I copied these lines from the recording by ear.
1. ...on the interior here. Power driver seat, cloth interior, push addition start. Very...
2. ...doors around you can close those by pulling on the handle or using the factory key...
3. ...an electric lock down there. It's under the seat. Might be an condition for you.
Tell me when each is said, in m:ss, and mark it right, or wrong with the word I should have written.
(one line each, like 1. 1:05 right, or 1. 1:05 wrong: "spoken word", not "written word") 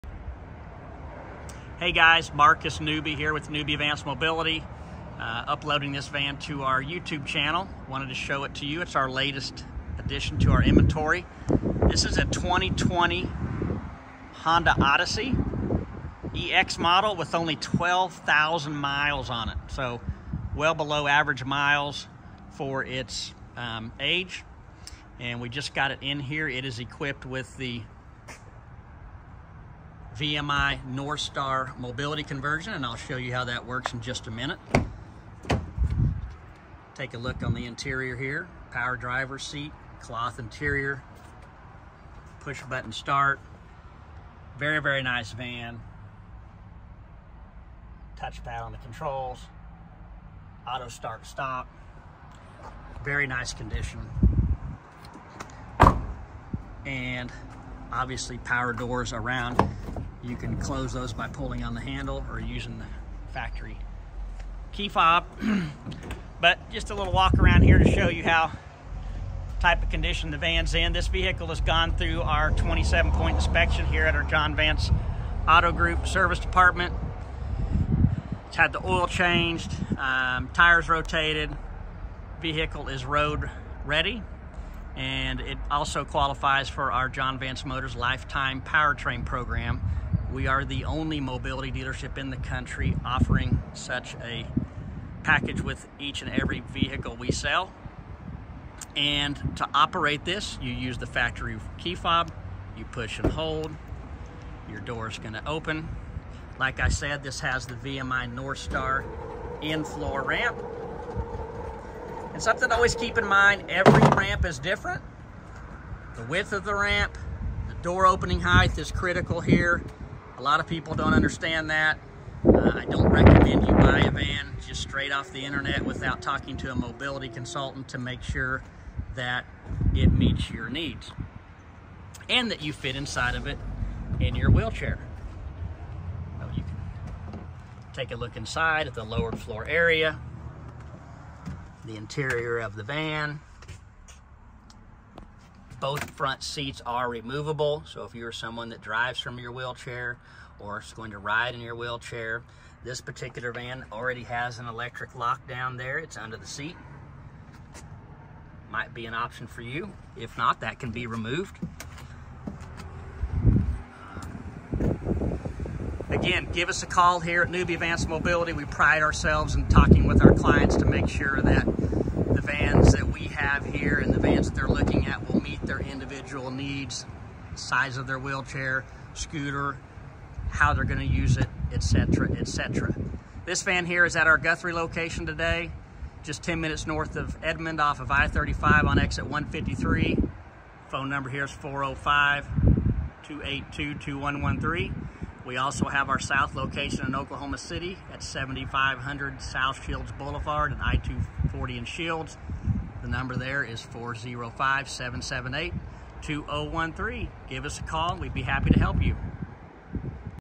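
1. 0:37 wrong: "button", not "addition"
2. 0:58 right
3. 2:34 wrong: "option", not "condition".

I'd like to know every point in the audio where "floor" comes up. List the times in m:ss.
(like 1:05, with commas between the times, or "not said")
1:49, 2:19.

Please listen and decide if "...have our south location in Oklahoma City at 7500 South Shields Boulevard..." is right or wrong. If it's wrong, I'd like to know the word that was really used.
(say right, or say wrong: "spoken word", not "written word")
right.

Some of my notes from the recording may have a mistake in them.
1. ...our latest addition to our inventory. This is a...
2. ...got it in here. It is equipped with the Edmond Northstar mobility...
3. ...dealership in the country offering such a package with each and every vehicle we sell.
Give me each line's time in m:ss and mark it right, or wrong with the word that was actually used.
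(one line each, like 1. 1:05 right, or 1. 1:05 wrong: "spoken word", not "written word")
1. 0:08 right
2. 0:25 wrong: "VMI", not "Edmond"
3. 1:31 right.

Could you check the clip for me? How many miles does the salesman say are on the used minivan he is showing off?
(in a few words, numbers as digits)
12,000.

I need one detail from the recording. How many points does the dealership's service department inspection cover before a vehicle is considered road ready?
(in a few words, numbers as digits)
27.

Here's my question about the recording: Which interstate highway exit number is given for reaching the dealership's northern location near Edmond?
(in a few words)
153.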